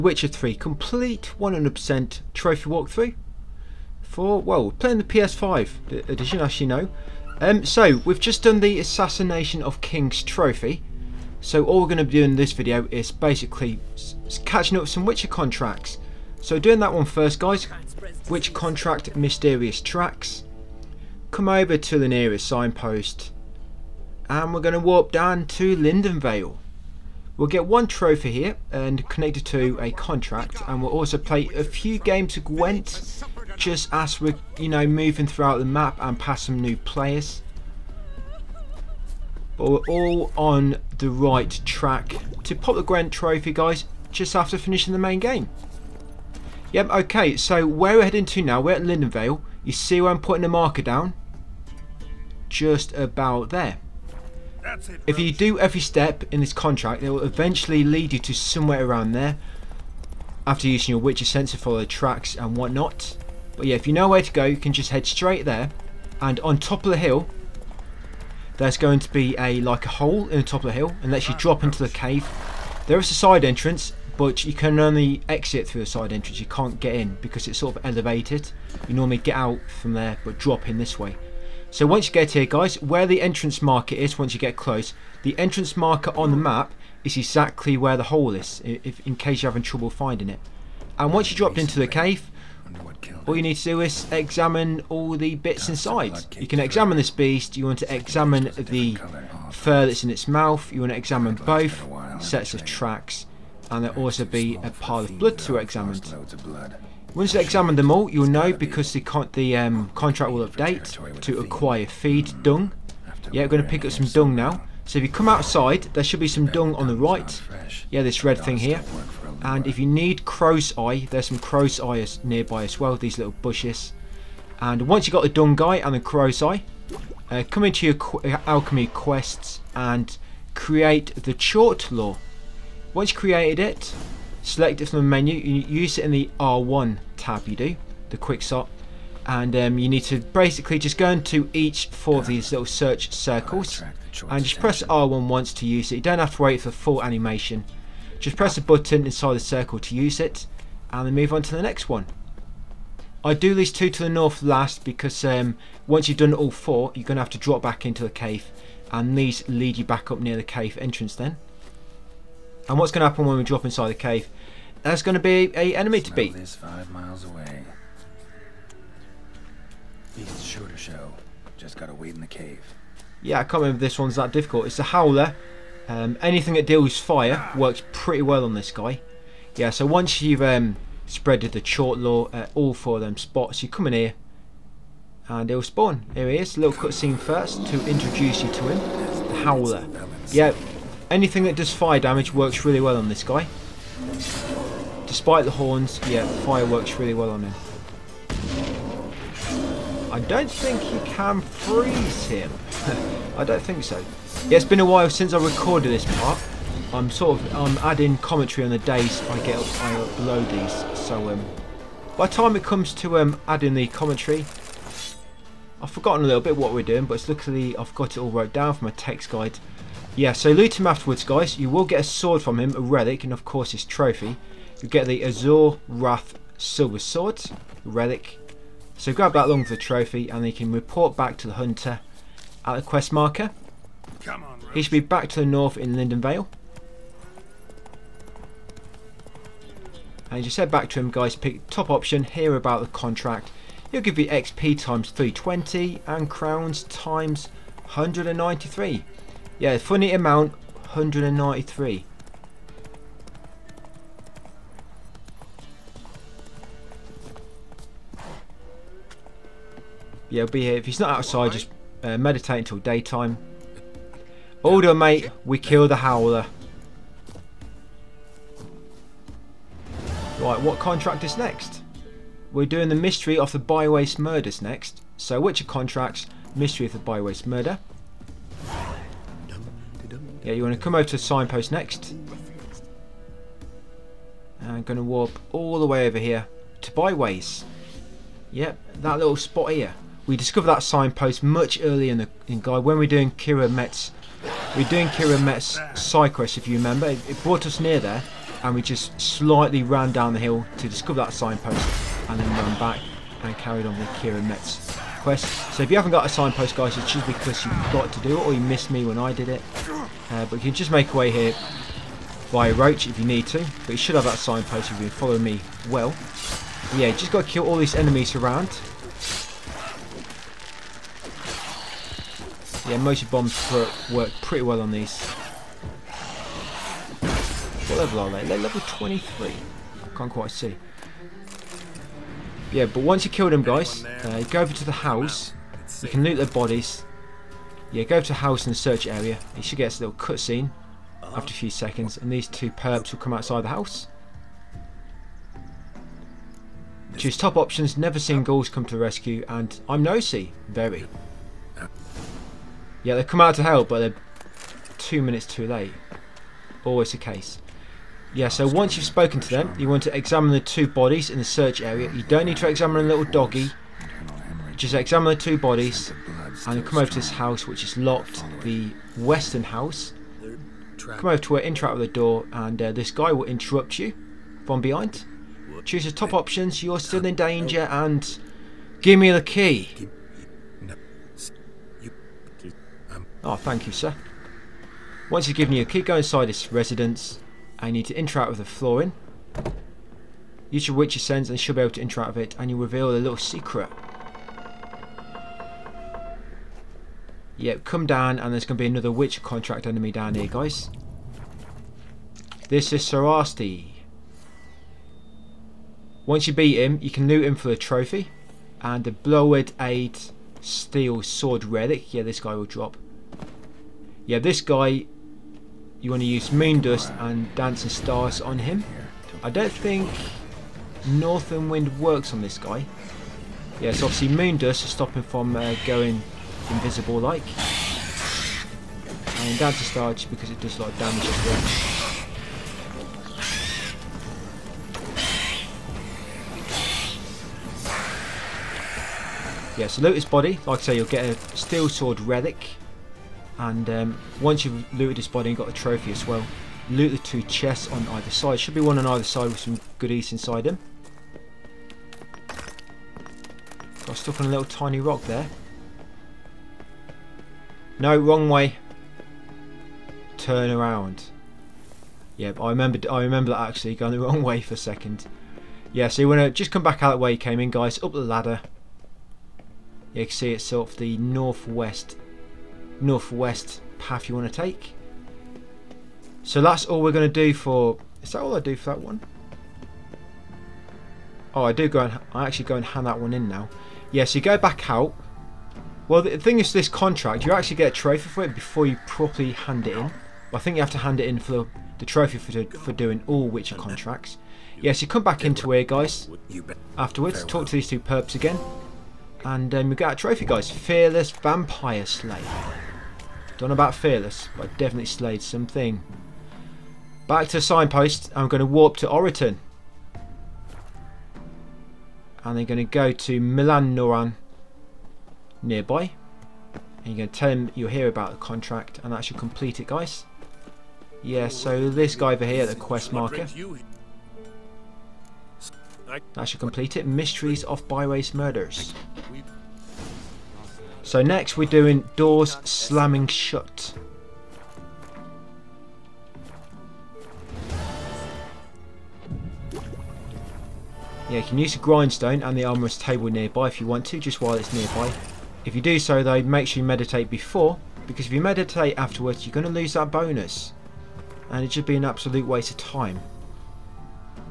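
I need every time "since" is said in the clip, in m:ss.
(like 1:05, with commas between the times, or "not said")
3:25.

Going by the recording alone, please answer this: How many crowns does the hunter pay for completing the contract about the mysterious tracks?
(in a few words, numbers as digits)
193.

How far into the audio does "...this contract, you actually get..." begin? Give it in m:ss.
8:06.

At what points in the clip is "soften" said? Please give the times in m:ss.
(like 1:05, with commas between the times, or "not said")
not said.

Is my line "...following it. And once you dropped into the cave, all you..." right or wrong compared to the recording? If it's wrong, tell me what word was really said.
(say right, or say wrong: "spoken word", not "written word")
wrong: "finding", not "following".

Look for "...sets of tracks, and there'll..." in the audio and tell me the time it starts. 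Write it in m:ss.
1:42.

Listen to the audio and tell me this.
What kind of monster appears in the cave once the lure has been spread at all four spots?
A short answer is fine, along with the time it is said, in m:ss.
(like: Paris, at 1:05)
A howler, at 2:54.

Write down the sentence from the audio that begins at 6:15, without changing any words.
Choose the top options, you're still in danger, and give me the key.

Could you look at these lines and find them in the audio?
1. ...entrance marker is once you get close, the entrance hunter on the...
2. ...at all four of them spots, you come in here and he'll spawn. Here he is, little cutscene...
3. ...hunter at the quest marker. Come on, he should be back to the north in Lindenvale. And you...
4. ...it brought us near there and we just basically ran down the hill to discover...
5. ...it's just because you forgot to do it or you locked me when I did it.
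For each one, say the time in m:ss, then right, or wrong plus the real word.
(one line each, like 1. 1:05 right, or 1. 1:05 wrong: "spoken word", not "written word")
1. 1:23 wrong: "marker", not "hunter"
2. 3:02 right
3. 3:51 right
4. 4:57 wrong: "slightly", not "basically"
5. 5:06 wrong: "missed", not "locked".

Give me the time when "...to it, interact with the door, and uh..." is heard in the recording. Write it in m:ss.
6:11.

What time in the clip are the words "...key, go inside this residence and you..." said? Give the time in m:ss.
6:25.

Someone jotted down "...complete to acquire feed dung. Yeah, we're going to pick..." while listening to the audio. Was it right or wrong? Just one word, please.
wrong.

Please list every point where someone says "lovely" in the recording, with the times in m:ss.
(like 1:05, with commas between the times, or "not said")
not said.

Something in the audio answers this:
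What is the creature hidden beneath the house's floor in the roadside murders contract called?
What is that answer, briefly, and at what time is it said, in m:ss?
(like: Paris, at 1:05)
Sarasti, at 6:42.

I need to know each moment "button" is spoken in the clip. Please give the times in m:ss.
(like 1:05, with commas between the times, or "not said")
2:28.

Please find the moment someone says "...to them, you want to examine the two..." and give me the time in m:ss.
5:59.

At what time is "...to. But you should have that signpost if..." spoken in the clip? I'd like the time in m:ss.
5:13.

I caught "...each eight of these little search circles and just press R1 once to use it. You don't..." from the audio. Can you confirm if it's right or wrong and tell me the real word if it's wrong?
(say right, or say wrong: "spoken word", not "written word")
wrong: "four", not "eight".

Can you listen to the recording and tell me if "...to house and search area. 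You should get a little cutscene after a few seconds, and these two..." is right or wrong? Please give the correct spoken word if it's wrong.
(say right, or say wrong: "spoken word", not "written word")
right.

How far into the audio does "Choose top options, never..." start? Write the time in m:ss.
5:47.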